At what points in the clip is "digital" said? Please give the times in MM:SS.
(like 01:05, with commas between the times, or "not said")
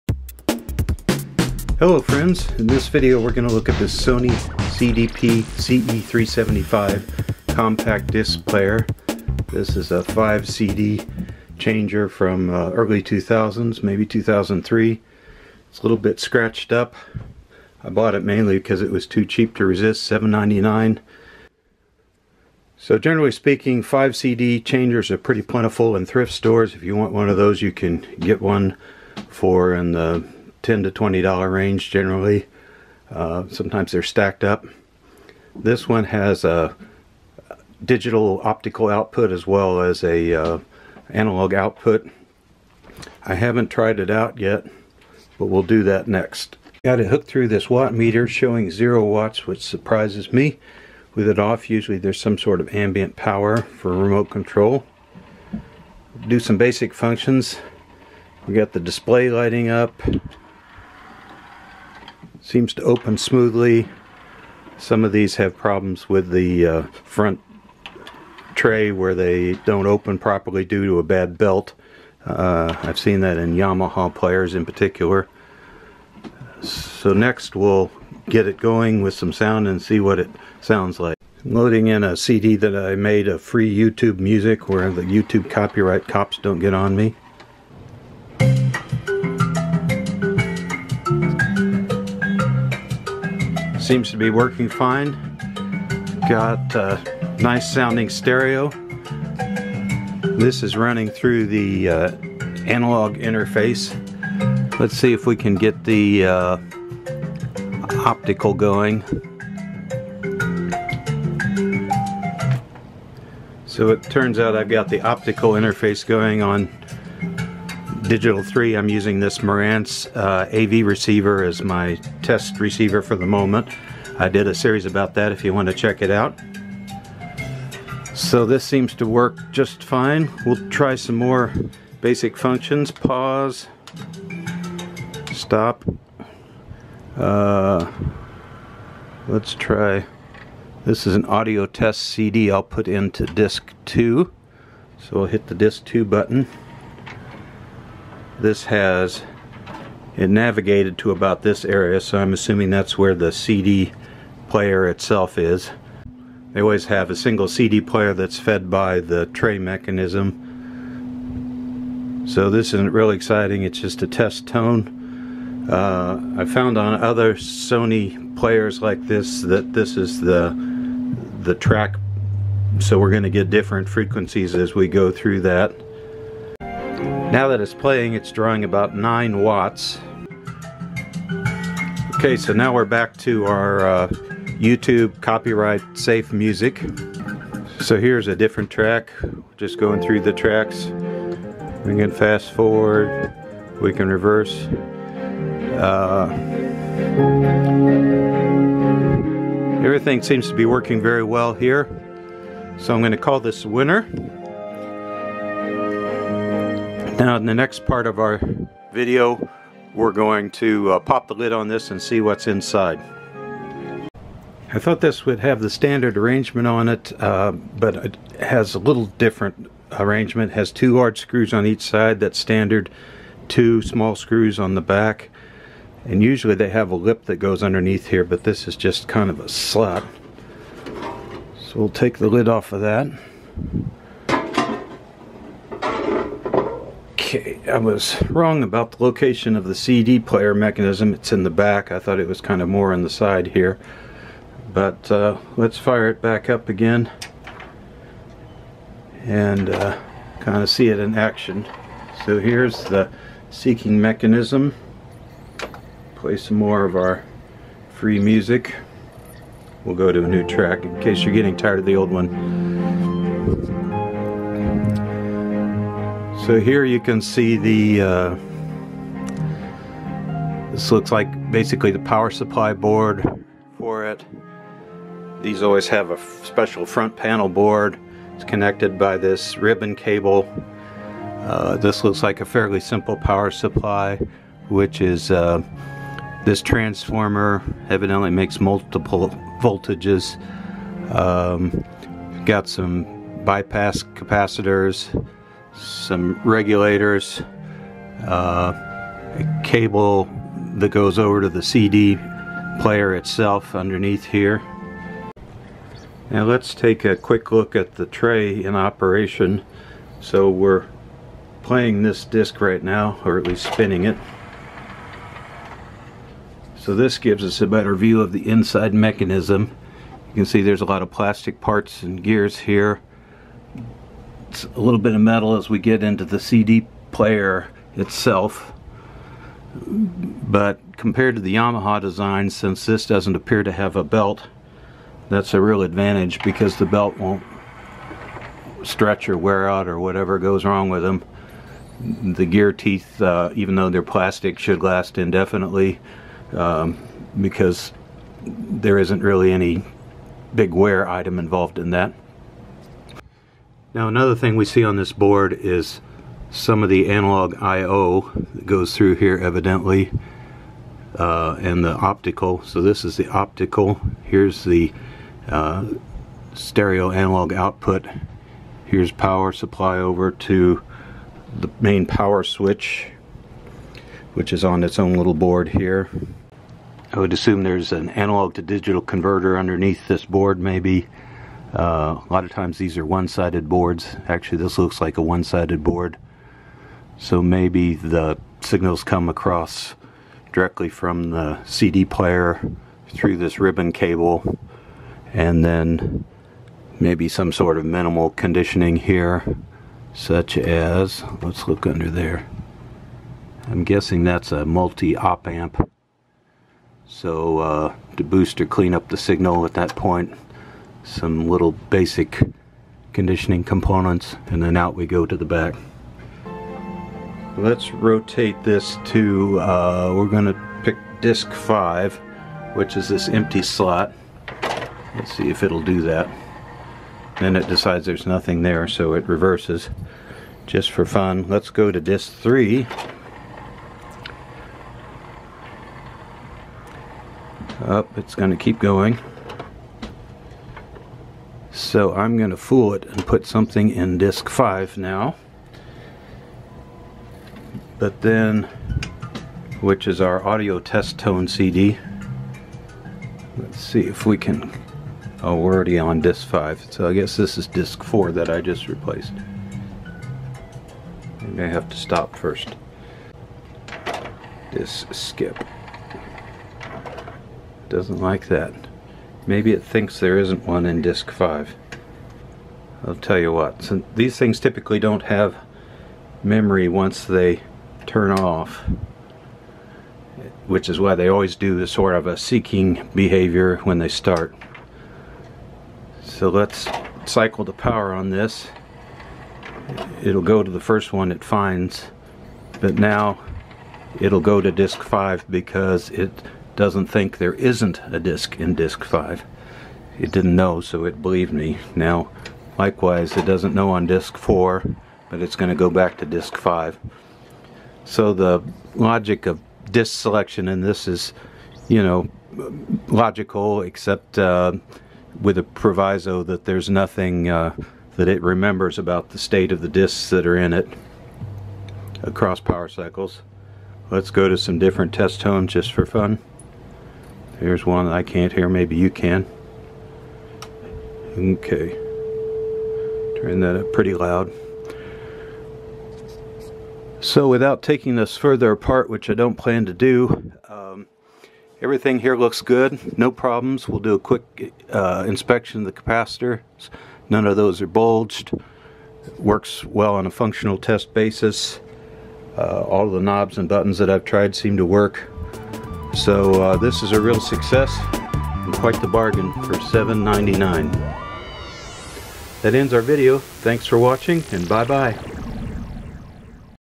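00:37, 01:58, 06:18.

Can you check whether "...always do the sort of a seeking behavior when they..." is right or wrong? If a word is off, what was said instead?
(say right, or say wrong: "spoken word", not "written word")
right.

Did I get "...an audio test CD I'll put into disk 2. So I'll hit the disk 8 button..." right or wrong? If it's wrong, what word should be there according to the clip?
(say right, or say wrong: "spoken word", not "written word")
wrong: "2", not "8".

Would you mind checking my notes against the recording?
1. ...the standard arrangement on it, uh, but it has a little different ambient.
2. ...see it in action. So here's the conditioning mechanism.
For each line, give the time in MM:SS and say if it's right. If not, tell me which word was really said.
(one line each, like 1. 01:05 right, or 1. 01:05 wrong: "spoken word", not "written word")
1. 03:35 wrong: "arrangement", not "ambient"
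2. 04:10 wrong: "seeking", not "conditioning".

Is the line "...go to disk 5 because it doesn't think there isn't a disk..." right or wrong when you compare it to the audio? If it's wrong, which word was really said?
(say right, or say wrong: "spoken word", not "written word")
right.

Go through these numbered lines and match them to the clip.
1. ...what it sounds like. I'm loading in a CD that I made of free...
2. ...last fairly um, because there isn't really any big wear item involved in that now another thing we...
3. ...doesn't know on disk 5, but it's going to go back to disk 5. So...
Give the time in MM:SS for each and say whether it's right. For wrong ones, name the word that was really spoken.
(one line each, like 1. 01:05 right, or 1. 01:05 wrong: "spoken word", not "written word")
1. 01:19 right
2. 05:44 wrong: "indefinitely", not "fairly"
3. 08:23 wrong: "4", not "5".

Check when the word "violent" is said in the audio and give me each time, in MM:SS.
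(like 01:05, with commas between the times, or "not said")
not said.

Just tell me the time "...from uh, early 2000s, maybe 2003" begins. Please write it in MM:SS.
00:12.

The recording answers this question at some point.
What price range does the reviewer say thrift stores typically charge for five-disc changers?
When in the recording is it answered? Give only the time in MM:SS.
00:30.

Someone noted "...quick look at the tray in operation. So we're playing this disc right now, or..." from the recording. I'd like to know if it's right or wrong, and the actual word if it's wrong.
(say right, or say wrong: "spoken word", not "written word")
right.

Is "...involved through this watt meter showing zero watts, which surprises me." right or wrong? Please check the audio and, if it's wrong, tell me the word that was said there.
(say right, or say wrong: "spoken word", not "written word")
wrong: "hooked", not "involved".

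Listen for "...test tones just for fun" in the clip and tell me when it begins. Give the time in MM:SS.
08:45.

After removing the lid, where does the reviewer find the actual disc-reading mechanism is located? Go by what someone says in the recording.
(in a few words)
In the back.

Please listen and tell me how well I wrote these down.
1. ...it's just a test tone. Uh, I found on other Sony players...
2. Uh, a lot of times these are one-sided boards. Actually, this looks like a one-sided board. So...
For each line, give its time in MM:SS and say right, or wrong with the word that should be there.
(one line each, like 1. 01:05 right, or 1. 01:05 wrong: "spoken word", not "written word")
1. 02:43 right
2. 06:21 right.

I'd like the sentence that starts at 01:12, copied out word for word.
Uh, I've seen that in Yamaha players in particular.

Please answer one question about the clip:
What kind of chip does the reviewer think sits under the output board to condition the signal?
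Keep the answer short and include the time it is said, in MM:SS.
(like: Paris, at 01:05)
Multi-op amp, at 06:44.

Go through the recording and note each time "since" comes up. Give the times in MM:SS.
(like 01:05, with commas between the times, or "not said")
05:32, 07:53.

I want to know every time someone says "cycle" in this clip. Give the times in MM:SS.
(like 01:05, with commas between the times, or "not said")
08:07, 08:42.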